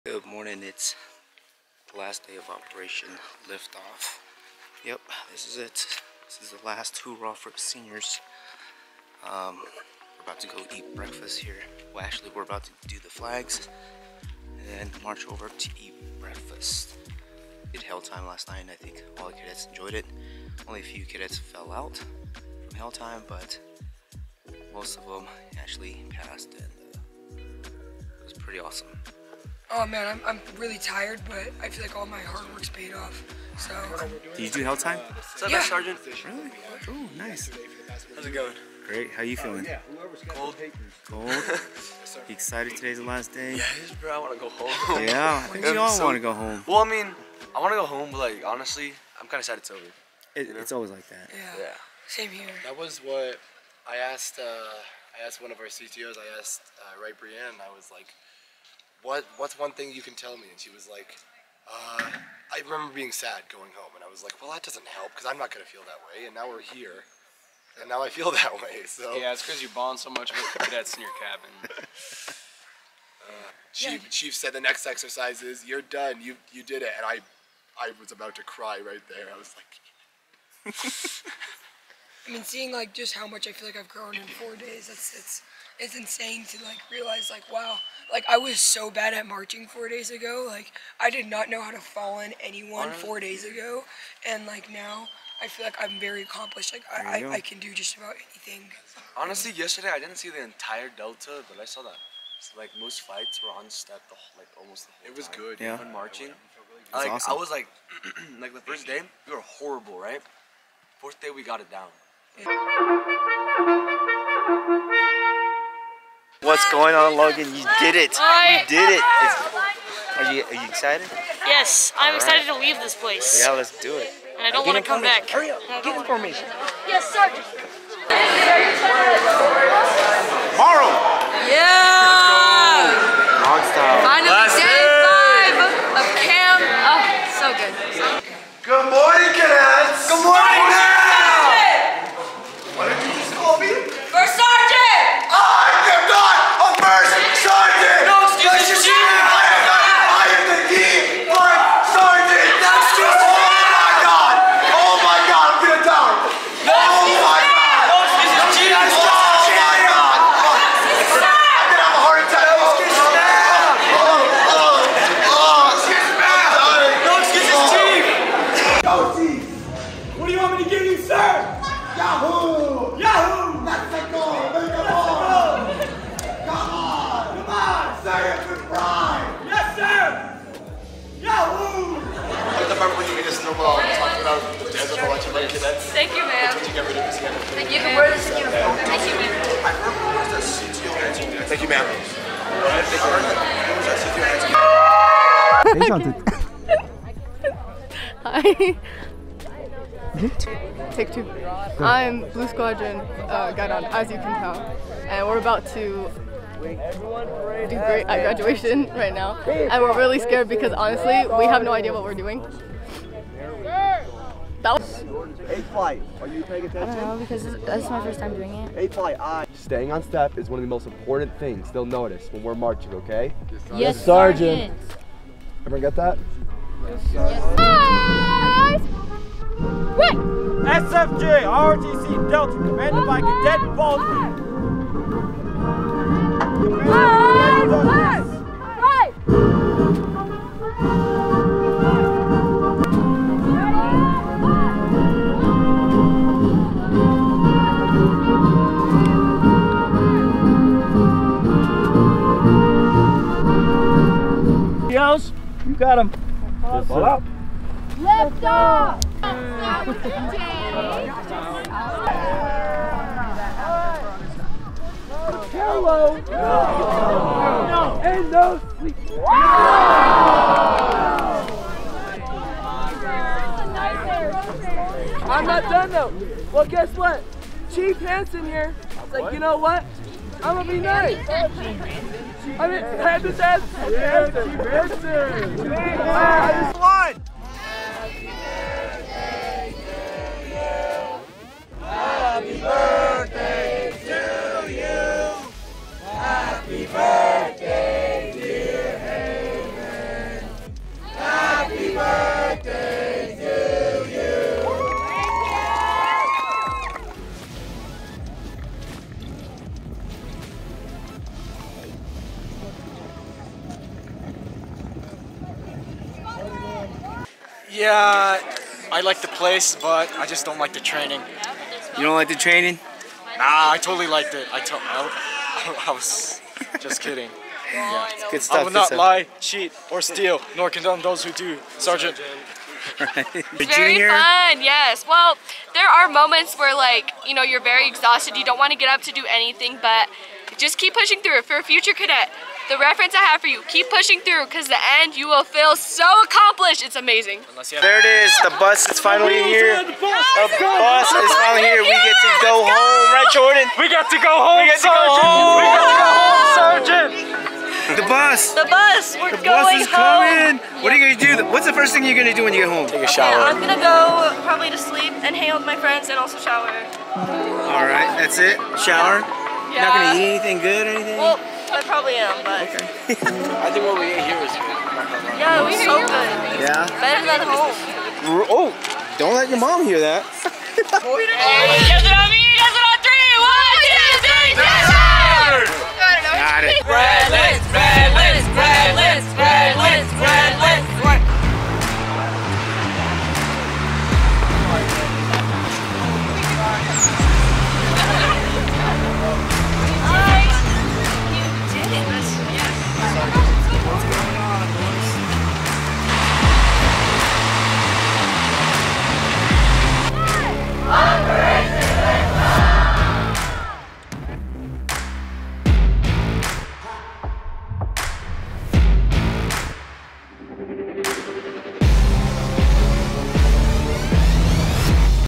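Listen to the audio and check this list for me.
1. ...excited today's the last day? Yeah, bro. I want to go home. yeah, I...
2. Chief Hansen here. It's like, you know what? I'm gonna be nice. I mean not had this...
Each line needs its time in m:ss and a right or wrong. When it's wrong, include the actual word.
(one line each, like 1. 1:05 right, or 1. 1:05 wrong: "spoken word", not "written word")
1. 0:42 right
2. 4:37 right.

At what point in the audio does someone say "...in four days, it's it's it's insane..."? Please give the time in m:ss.
1:24.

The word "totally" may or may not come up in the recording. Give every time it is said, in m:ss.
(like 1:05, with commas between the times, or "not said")
5:23.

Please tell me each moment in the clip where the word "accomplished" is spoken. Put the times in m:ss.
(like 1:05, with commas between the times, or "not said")
1:36, 5:46.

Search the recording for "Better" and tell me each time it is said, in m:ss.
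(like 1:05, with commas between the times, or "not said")
6:16.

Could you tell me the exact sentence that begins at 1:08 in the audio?
So yeah, it's because you bond so much with cadets in your cabin.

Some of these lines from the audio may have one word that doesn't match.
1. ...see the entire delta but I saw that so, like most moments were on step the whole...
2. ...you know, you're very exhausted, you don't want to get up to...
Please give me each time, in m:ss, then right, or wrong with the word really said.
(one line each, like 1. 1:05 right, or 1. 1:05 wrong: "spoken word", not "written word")
1. 1:40 wrong: "fights", not "moments"
2. 5:37 right.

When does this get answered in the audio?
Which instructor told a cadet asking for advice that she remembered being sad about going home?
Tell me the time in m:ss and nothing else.
0:57.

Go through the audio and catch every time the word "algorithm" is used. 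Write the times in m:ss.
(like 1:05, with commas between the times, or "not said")
not said.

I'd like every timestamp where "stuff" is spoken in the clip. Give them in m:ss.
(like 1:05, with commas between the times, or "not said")
5:28.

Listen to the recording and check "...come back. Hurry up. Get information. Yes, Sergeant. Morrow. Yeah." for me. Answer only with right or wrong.
right.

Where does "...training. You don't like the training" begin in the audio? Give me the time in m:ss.
5:20.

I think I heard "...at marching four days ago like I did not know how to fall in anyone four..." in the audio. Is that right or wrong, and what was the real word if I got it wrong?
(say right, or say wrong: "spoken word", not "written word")
right.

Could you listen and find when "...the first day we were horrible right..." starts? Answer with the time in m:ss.
1:48.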